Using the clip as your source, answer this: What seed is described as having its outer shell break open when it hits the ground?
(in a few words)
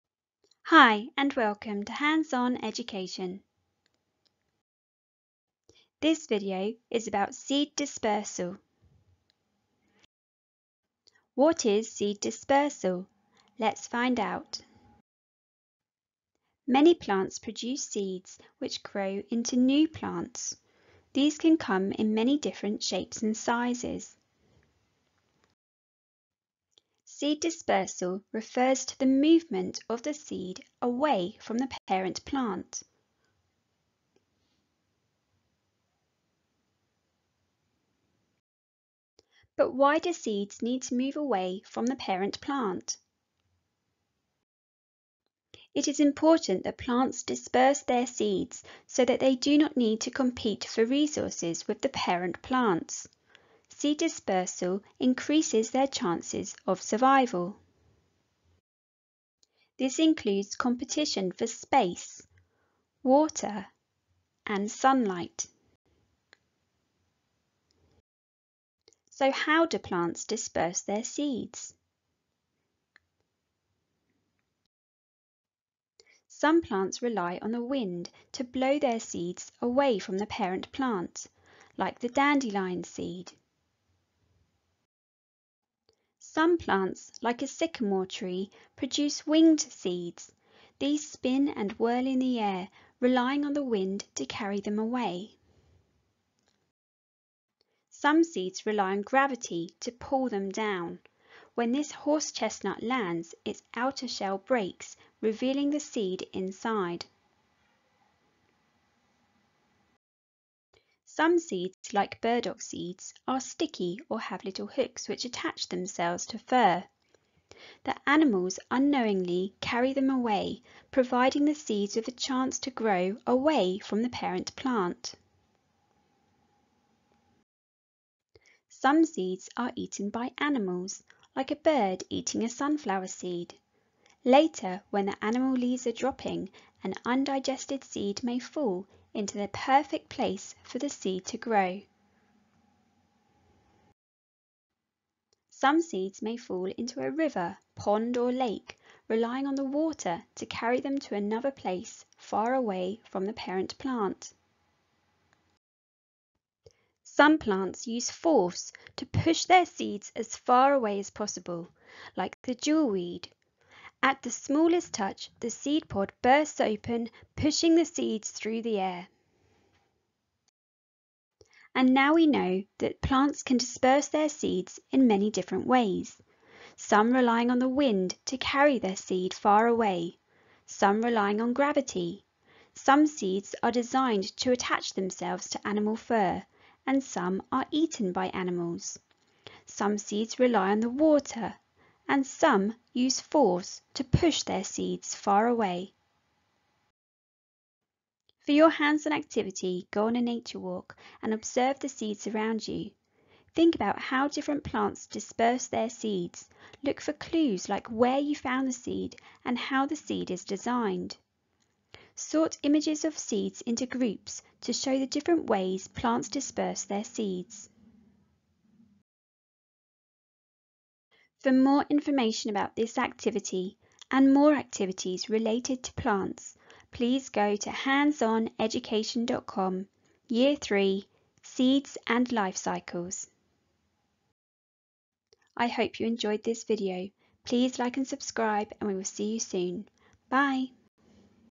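Horse chestnut.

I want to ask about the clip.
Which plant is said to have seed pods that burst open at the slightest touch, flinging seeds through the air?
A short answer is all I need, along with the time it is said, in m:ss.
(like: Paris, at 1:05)
Jewelweed, at 2:42.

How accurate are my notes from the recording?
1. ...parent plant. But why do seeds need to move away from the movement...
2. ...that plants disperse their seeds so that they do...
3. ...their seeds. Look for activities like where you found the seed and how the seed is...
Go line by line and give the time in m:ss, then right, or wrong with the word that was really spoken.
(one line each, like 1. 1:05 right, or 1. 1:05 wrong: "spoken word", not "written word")
1. 0:31 wrong: "parent", not "movement"
2. 0:46 right
3. 3:25 wrong: "clues", not "activities".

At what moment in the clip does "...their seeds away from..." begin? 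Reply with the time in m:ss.
1:18.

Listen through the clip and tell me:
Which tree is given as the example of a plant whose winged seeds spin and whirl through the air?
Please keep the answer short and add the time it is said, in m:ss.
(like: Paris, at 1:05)
Sycamore, at 1:27.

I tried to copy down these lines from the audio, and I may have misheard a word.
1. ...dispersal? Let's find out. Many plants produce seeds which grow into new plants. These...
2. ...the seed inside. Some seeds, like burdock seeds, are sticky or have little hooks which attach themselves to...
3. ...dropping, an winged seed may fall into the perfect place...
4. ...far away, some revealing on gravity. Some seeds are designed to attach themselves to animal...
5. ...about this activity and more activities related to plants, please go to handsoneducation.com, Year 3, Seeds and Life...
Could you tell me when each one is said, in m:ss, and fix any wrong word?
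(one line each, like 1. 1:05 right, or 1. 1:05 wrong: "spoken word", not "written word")
1. 0:12 right
2. 1:45 right
3. 2:15 wrong: "undigested", not "winged"
4. 2:59 wrong: "relying", not "revealing"
5. 3:42 right.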